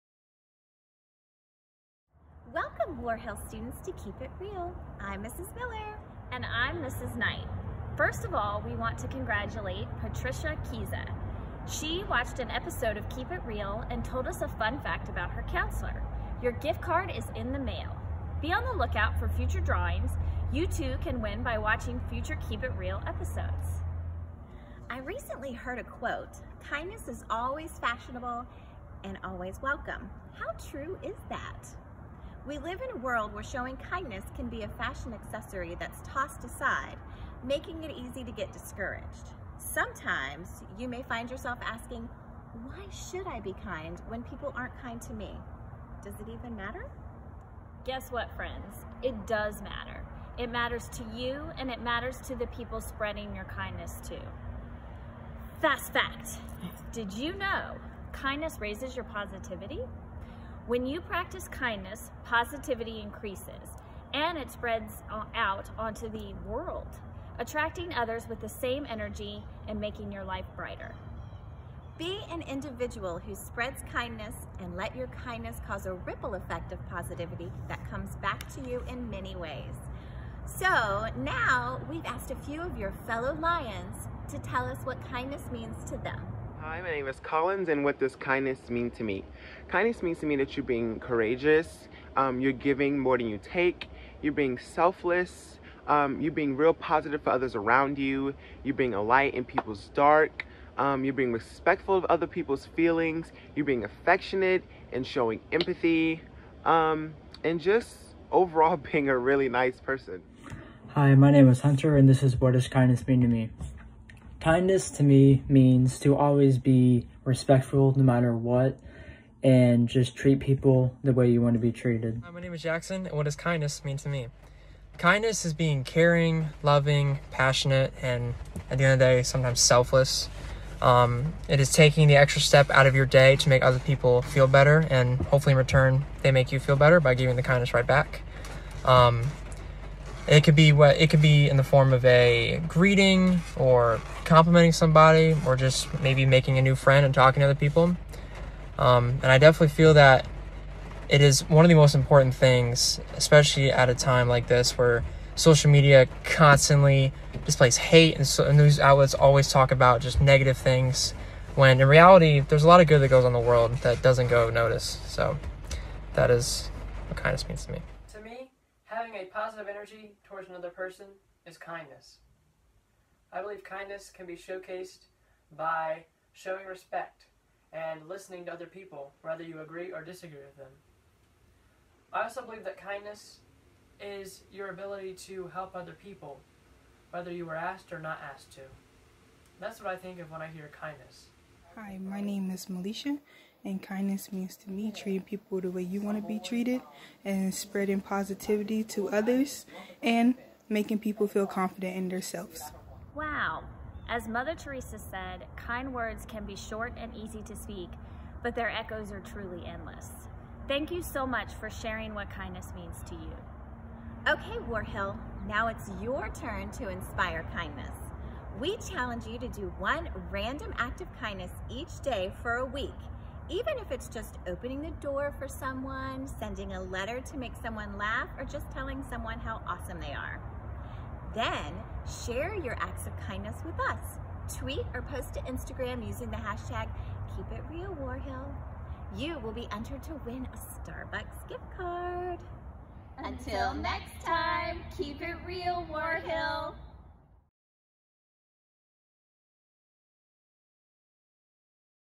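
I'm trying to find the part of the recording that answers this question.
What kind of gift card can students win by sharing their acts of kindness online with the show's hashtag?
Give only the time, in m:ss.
4:00.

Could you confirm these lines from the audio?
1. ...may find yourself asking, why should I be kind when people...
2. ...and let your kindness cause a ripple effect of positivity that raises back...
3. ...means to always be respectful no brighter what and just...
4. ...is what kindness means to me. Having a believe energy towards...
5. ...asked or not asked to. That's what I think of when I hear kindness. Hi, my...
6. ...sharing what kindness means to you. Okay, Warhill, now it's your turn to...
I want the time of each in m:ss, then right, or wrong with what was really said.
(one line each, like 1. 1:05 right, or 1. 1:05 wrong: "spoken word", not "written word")
1. 0:40 right
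2. 1:14 wrong: "comes", not "raises"
3. 1:55 wrong: "matter", not "brighter"
4. 2:46 wrong: "positive", not "believe"
5. 3:07 right
6. 3:31 right.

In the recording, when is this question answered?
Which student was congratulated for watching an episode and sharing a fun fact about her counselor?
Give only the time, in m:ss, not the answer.
0:10.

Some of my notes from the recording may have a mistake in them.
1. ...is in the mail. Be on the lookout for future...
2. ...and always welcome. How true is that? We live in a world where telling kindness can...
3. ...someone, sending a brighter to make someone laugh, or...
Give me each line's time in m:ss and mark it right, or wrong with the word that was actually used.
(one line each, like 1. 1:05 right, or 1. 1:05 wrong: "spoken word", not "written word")
1. 0:17 right
2. 0:29 wrong: "showing", not "telling"
3. 3:45 wrong: "letter", not "brighter".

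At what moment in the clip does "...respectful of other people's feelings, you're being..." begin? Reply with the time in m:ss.
1:41.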